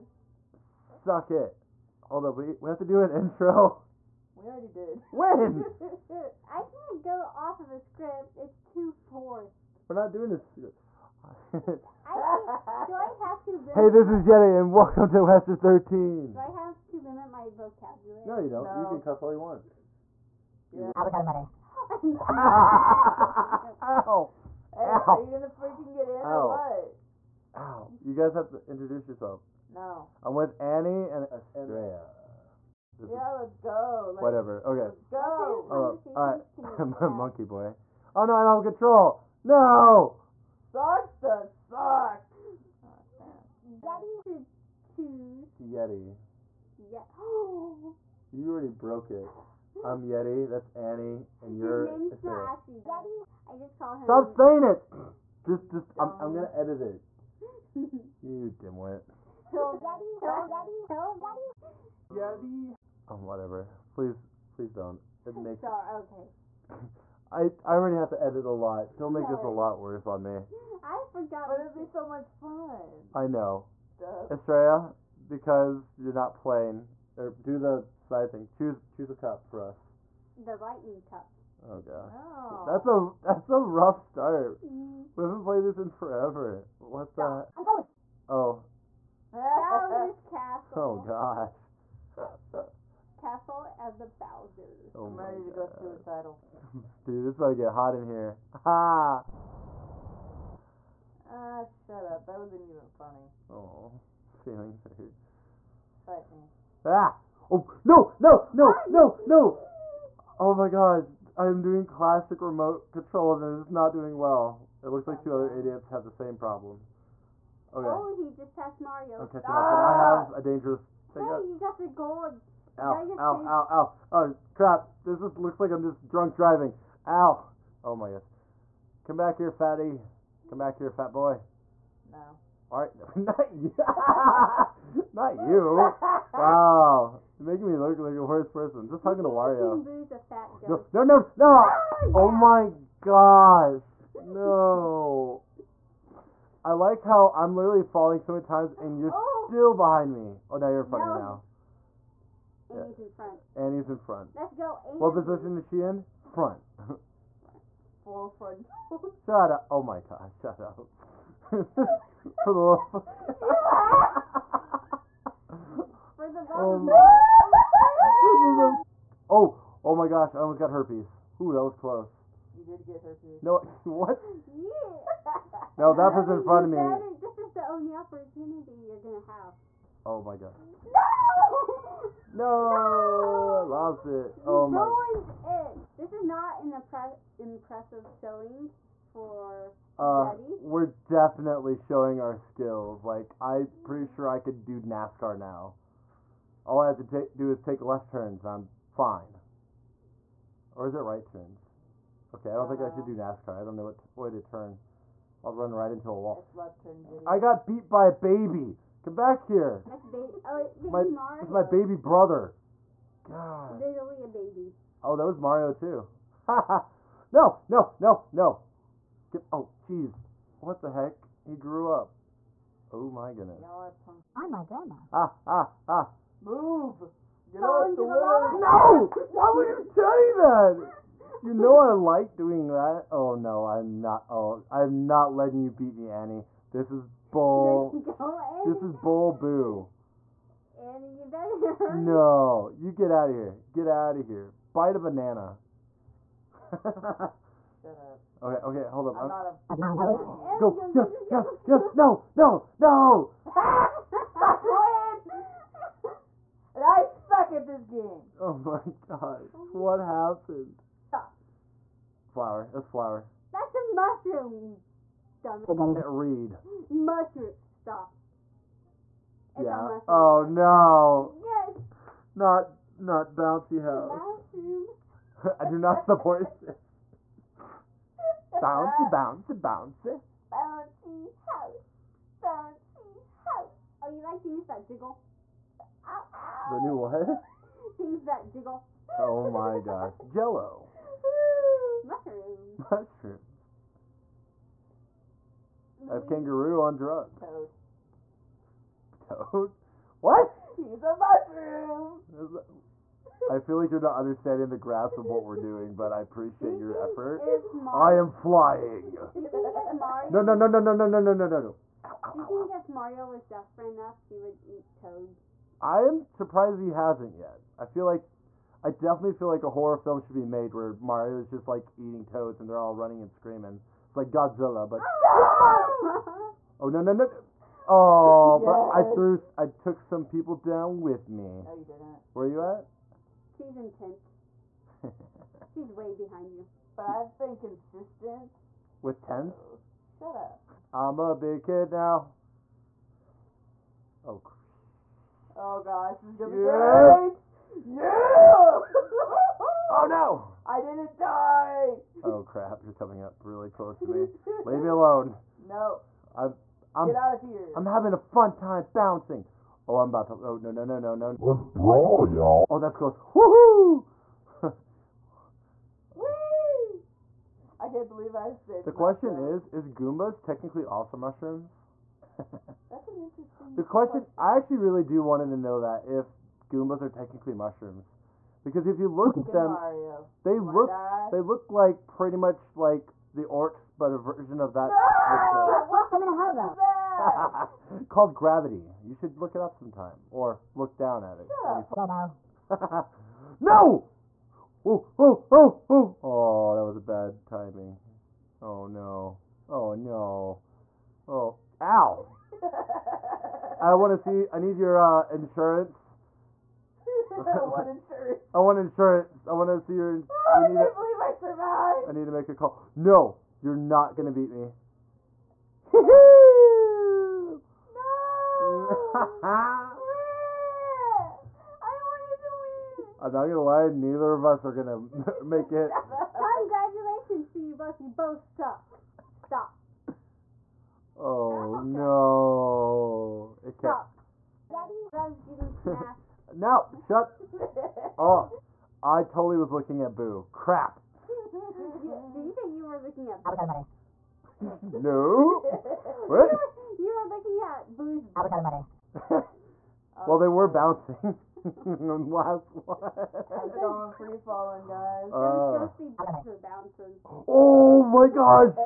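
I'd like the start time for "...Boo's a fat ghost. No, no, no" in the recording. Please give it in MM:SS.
02:19.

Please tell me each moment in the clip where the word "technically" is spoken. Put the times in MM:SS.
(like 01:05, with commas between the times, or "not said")
06:10, 06:17.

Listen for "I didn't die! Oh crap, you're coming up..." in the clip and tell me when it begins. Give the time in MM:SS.
05:50.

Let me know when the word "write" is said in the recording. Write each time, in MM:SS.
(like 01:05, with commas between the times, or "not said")
not said.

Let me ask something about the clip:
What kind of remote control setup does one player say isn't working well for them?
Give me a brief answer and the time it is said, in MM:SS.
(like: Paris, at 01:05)
Classic, at 01:51.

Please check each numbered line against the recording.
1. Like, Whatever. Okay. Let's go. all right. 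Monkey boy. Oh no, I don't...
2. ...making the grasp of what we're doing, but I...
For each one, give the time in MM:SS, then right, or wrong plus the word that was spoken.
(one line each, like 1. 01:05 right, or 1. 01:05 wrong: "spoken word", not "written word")
1. 00:34 right
2. 05:04 wrong: "understanding", not "making".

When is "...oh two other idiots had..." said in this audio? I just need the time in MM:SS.
01:55.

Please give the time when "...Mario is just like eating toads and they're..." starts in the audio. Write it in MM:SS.
05:20.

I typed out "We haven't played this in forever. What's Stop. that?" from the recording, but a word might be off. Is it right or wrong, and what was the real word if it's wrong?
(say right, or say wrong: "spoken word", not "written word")
right.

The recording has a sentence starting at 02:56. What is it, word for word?
Better, this is the only opportunity you're going to have.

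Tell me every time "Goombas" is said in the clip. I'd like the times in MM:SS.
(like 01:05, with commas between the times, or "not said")
06:09, 06:16.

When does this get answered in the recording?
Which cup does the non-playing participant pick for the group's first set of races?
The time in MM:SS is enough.
01:20.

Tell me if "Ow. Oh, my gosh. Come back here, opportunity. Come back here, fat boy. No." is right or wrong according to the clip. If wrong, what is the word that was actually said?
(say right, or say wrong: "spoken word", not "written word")
wrong: "fatty", not "opportunity".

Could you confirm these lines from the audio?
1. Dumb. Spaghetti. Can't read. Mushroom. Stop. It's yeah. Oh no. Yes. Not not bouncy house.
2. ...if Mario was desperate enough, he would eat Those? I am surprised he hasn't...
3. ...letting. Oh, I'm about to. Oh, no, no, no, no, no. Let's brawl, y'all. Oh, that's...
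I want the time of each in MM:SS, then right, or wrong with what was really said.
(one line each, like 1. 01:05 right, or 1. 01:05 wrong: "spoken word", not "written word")
1. 04:25 right
2. 05:12 wrong: "Toad", not "Those"
3. 05:58 wrong: "bouncing", not "letting".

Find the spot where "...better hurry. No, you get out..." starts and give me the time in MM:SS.
04:01.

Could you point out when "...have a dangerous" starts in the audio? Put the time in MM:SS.
02:00.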